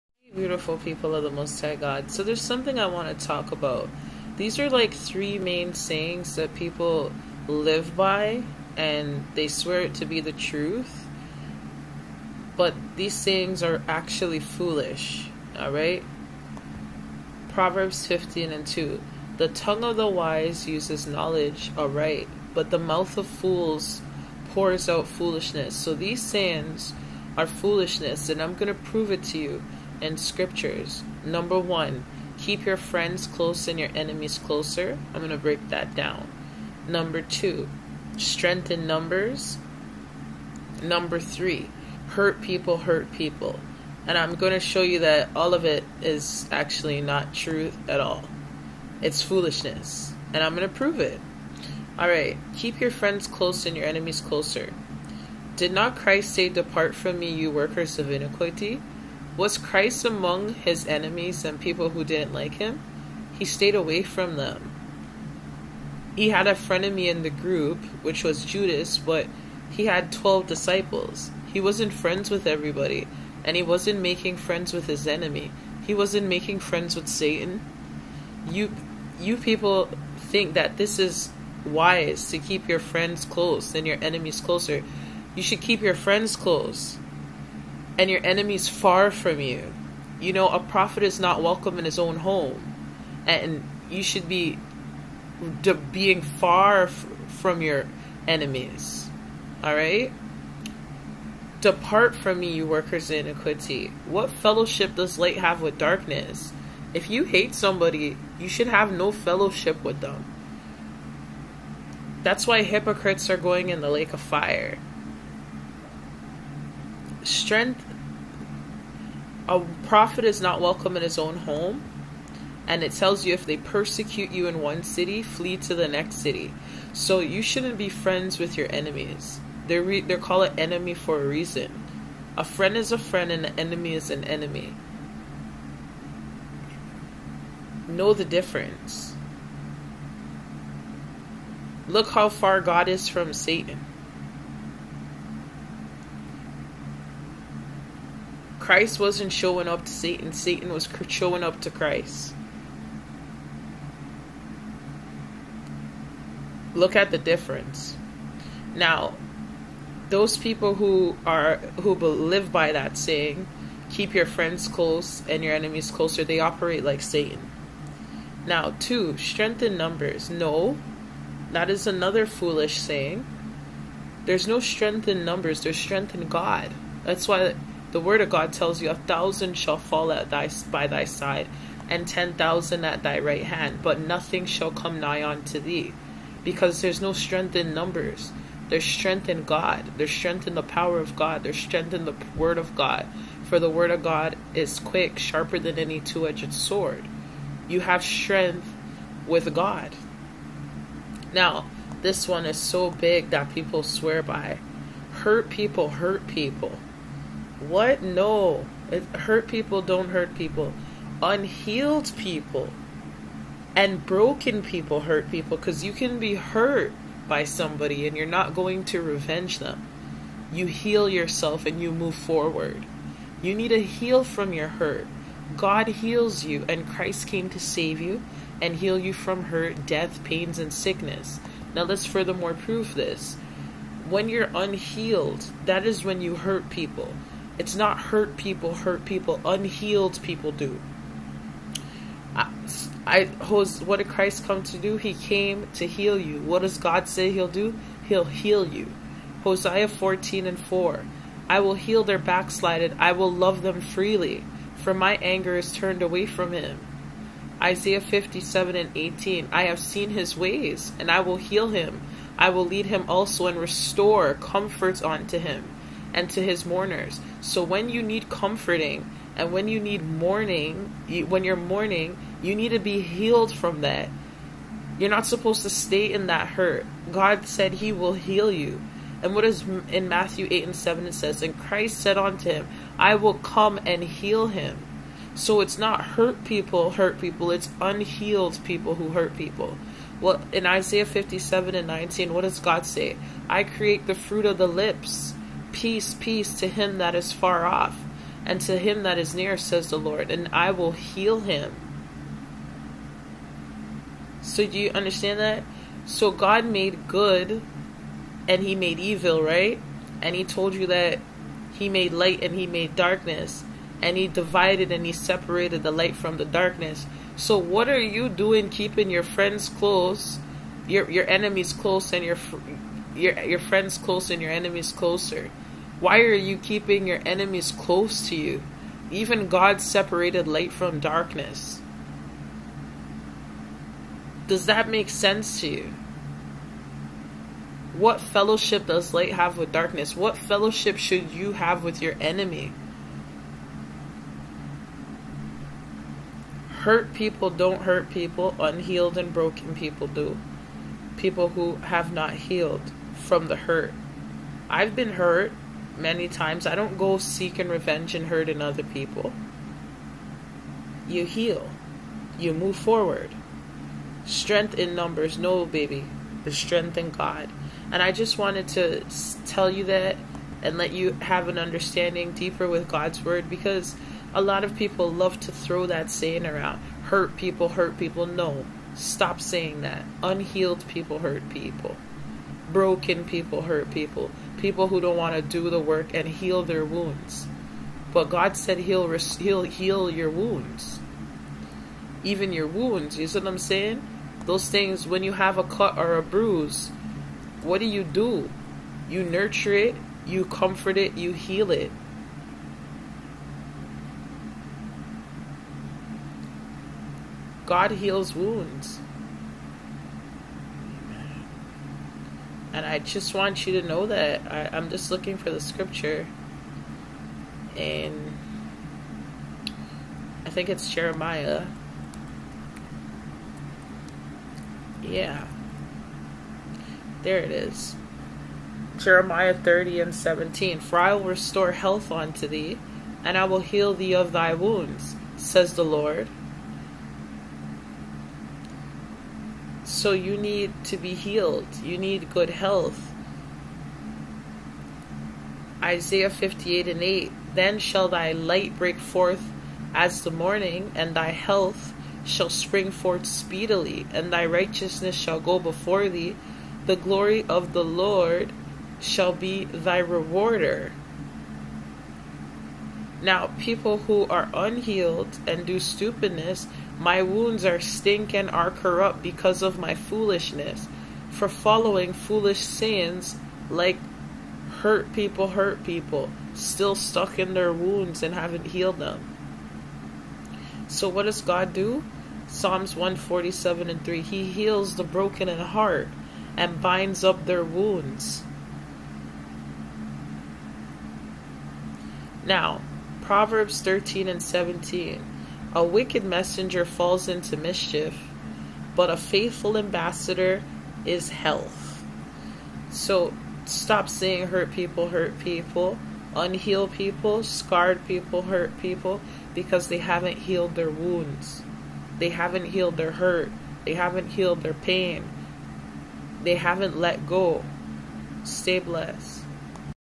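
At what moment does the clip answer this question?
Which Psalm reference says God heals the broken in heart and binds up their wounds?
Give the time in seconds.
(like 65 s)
482 s.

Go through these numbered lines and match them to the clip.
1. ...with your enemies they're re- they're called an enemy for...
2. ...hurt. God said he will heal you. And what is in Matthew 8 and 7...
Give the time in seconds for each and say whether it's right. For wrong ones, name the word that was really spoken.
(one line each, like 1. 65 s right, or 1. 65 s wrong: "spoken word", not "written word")
1. 128 s right
2. 276 s right.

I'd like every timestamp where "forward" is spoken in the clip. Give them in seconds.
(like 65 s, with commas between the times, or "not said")
222 s, 362 s.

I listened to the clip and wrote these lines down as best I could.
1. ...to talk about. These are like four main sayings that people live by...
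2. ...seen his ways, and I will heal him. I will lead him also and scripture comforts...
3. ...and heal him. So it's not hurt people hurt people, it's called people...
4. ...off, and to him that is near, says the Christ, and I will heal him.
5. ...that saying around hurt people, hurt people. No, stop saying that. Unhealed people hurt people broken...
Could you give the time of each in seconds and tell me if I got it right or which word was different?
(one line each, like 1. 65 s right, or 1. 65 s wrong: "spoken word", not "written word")
1. 3 s wrong: "three", not "four"
2. 259 s wrong: "restore", not "scripture"
3. 283 s wrong: "unhealed", not "called"
4. 297 s wrong: "Lord", not "Christ"
5. 375 s right.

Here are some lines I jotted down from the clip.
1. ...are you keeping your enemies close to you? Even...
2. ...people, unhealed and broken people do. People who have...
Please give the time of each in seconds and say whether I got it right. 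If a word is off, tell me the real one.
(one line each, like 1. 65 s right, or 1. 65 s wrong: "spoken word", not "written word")
1. 326 s right
2. 348 s right.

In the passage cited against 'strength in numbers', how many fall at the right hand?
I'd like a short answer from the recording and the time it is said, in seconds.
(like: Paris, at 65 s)
10,000, at 182 s.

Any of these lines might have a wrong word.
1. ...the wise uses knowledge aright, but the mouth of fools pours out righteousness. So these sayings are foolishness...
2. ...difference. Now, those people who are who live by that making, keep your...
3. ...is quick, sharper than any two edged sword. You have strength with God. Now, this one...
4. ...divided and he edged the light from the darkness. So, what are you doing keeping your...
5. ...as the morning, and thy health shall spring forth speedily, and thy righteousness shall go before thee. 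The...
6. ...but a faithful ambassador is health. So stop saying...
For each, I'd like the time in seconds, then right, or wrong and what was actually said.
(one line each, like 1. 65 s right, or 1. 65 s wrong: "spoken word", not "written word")
1. 19 s wrong: "foolishness", not "righteousness"
2. 157 s wrong: "saying", not "making"
3. 194 s right
4. 314 s wrong: "separated", not "edged"
5. 449 s right
6. 498 s right.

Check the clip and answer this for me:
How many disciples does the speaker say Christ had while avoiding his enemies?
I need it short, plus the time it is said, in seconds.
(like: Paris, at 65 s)
12, at 70 s.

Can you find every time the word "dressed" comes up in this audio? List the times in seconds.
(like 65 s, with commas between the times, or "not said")
not said.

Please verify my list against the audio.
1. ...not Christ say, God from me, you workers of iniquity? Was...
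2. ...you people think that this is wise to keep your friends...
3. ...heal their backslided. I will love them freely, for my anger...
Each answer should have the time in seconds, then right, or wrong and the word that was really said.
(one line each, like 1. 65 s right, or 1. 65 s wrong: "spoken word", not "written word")
1. 55 s wrong: "Depart", not "God"
2. 79 s right
3. 251 s right.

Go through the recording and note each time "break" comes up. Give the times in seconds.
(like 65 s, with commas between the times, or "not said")
35 s, 448 s.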